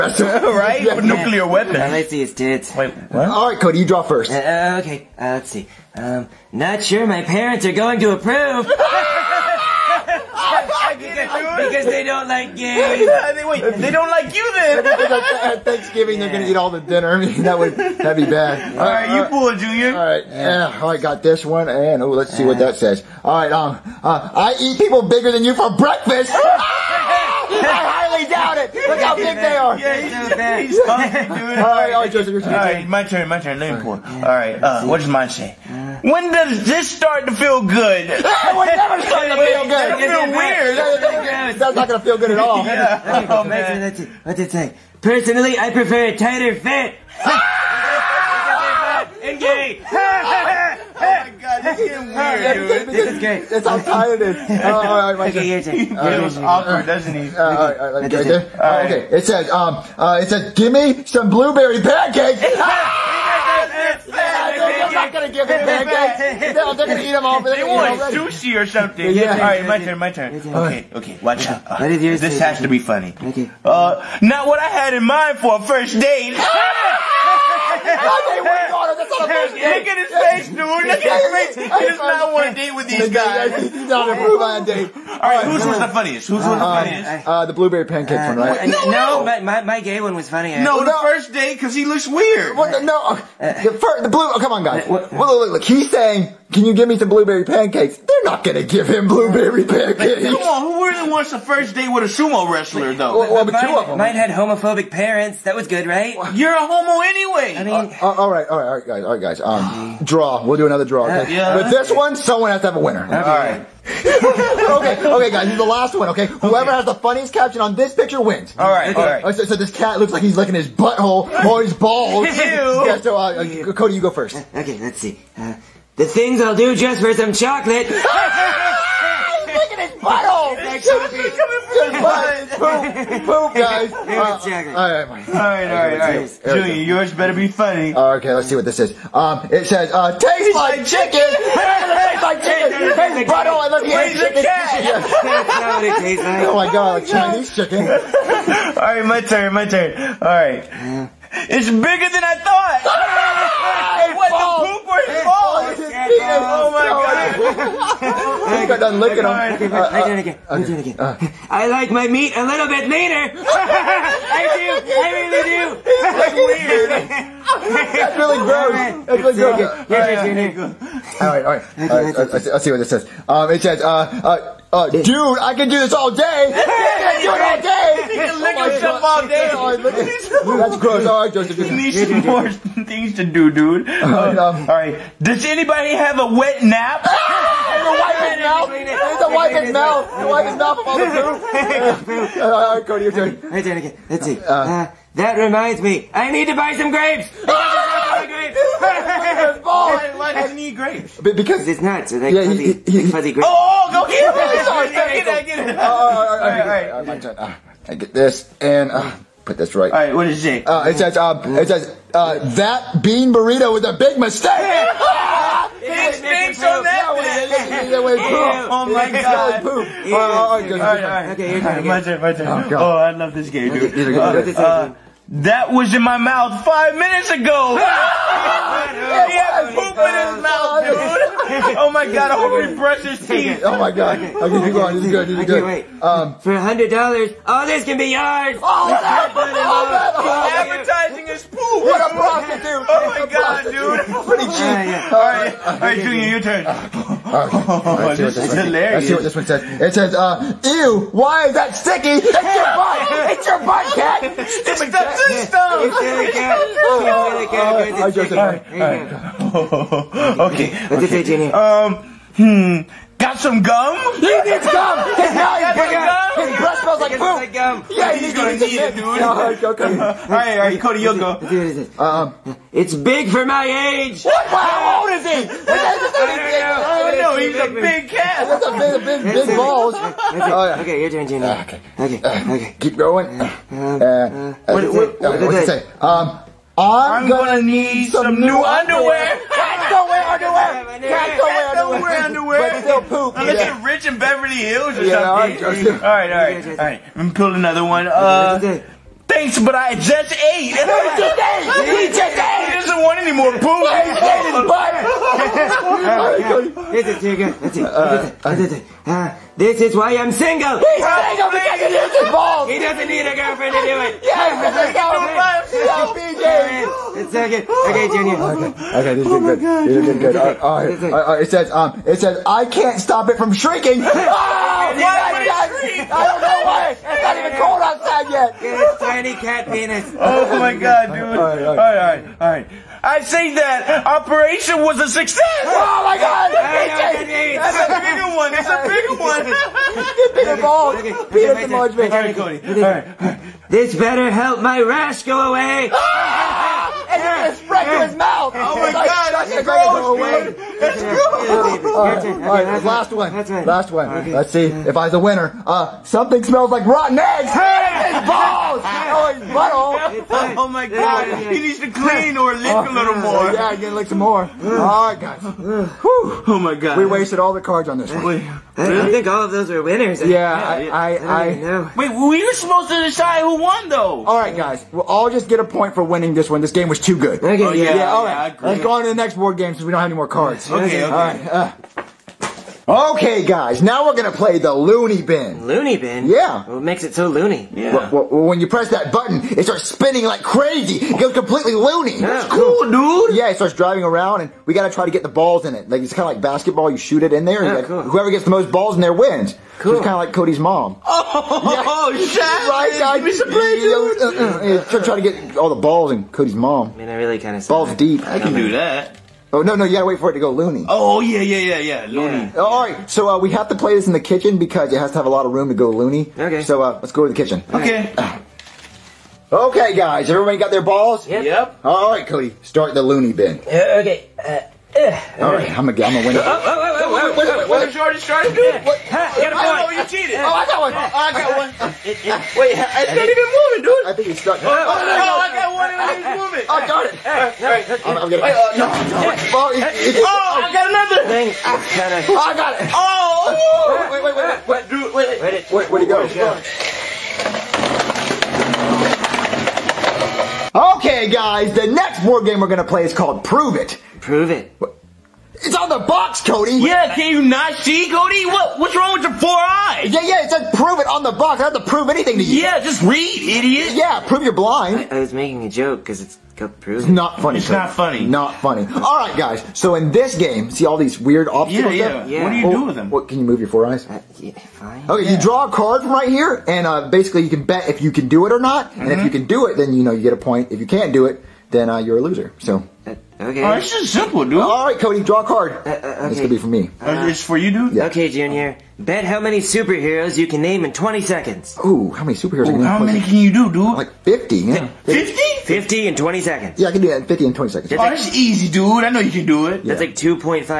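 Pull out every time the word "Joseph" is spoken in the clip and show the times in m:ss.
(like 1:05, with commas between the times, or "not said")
0:32, 3:01.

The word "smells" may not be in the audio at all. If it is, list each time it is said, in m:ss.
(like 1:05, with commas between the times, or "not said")
4:26, 5:56.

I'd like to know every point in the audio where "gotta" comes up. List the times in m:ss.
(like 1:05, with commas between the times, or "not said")
6:34, 6:49.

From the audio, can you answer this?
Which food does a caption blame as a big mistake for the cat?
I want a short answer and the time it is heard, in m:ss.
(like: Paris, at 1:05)
bean burrito, at 3:33.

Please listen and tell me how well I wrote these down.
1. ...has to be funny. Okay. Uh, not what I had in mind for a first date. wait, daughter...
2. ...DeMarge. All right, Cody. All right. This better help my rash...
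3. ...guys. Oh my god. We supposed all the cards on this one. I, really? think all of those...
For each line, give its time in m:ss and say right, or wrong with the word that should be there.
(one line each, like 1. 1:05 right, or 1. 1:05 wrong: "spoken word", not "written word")
1. 1:12 right
2. 5:41 right
3. 6:05 wrong: "wasted", not "supposed".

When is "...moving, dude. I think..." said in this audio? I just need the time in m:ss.
7:13.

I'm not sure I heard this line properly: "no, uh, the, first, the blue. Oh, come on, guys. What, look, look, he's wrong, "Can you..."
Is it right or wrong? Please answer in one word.
wrong.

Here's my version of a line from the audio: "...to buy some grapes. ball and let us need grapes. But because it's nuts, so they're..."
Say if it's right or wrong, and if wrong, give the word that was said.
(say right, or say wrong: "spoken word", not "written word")
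right.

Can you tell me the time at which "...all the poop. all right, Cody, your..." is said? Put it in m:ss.
3:10.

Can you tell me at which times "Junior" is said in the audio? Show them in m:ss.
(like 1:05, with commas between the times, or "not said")
0:19, 4:05, 5:18, 8:08.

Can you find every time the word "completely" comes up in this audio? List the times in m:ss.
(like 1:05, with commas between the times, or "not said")
6:31.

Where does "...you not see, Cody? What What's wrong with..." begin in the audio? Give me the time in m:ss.
7:37.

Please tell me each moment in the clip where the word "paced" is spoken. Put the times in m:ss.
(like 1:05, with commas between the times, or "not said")
not said.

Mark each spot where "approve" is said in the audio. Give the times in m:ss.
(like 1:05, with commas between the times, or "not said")
0:08, 1:24.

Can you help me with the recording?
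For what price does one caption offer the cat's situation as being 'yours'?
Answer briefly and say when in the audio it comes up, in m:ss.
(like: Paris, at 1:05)
$100, at 3:56.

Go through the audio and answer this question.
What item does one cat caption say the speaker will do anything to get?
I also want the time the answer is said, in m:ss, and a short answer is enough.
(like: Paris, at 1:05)
chocolate, at 2:07.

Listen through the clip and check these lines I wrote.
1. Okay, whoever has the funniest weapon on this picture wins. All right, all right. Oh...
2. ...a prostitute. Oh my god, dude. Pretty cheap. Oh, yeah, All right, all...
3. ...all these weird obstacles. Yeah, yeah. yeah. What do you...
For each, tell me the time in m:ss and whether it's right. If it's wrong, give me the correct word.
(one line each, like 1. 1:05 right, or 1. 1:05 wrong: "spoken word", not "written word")
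1. 1:56 wrong: "caption", not "weapon"
2. 4:02 right
3. 7:50 right.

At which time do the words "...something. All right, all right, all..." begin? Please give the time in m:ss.
4:55.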